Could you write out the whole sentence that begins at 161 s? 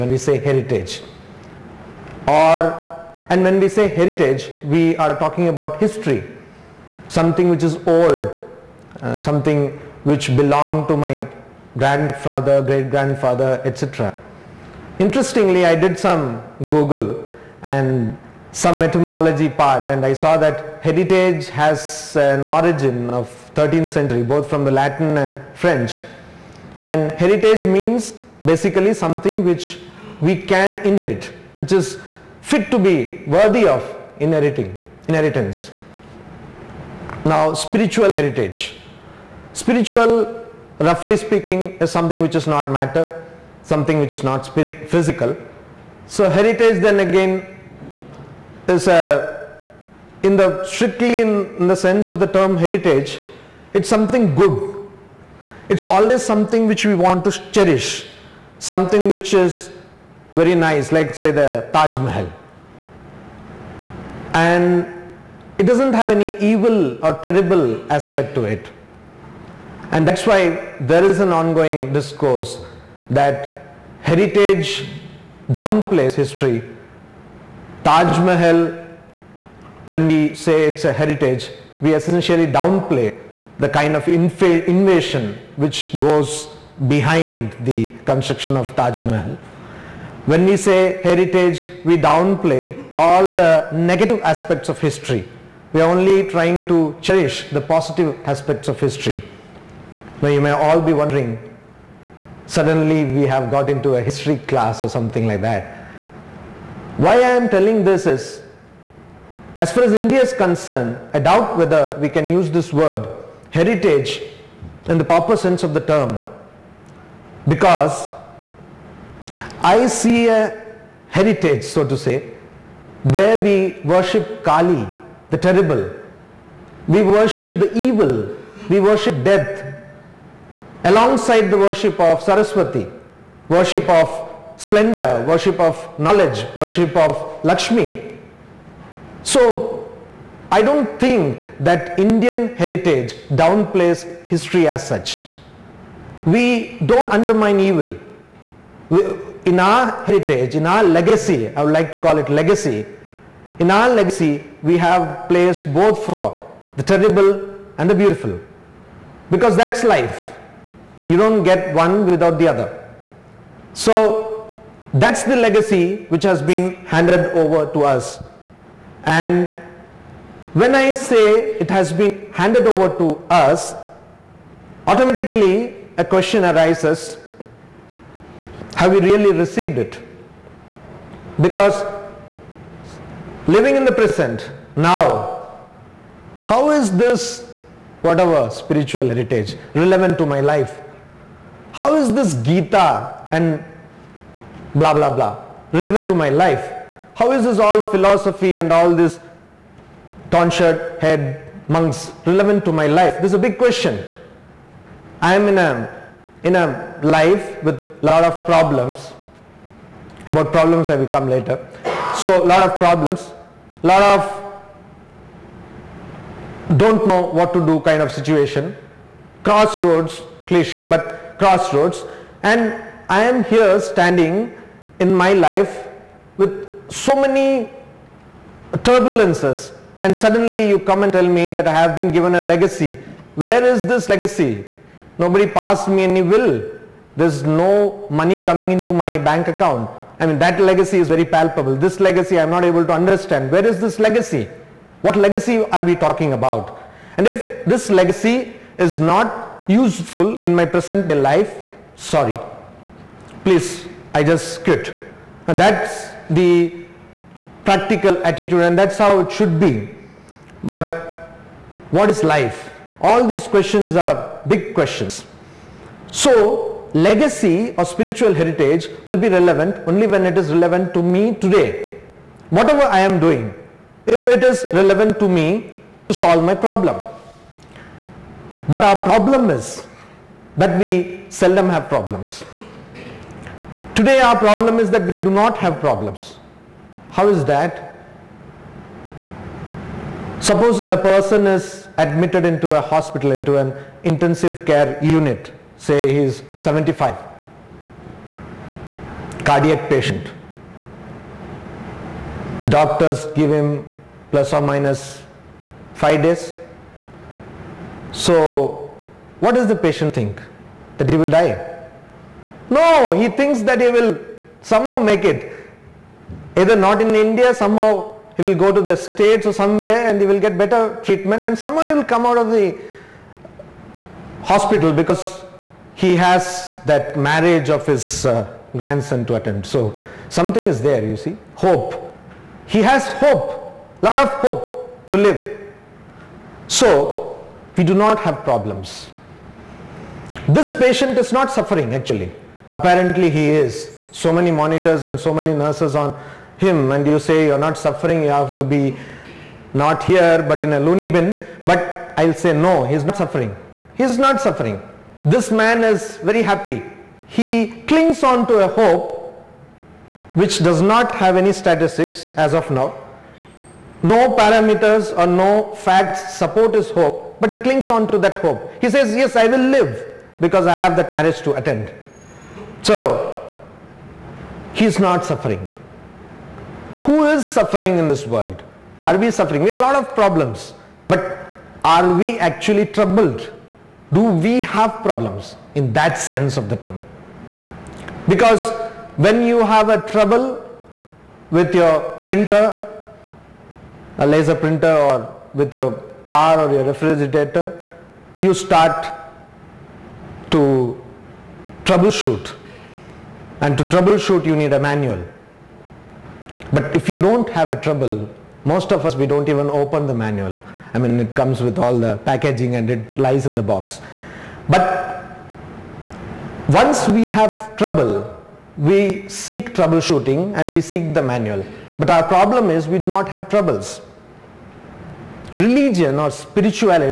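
You don't get one without the other.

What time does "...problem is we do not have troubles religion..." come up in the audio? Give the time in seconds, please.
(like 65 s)
422 s.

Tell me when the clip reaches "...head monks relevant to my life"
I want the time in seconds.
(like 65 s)
201 s.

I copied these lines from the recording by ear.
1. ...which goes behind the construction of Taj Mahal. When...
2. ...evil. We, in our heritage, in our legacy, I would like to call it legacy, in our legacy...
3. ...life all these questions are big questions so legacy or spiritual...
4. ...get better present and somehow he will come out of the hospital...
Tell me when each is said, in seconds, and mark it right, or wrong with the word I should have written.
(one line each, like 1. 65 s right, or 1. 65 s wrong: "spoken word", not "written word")
1. 85 s right
2. 147 s right
3. 262 s right
4. 320 s wrong: "treatment", not "present".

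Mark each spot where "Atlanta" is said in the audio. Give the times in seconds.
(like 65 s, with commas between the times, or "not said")
not said.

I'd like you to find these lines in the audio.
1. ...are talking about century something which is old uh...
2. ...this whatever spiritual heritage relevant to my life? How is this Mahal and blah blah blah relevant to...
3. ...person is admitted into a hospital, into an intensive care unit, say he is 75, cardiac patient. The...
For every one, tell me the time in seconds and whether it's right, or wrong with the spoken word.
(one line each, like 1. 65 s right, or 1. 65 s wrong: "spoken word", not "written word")
1. 4 s wrong: "history", not "century"
2. 186 s wrong: "Gita", not "Mahal"
3. 290 s right.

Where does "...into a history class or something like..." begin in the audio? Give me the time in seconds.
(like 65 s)
103 s.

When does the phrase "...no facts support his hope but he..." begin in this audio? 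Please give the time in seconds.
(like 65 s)
365 s.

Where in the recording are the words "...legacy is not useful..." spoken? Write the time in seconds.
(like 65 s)
247 s.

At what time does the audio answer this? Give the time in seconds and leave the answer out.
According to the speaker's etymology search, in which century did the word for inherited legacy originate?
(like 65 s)
23 s.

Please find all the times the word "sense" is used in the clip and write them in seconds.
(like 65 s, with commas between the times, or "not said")
51 s, 115 s, 386 s.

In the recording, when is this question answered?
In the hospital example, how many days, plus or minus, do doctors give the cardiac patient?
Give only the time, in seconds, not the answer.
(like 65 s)
305 s.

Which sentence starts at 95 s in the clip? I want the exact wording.
We are only trying to cherish the positive aspects of history.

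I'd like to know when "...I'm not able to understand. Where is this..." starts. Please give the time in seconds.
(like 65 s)
242 s.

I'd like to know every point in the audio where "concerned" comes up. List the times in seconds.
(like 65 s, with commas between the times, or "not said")
110 s.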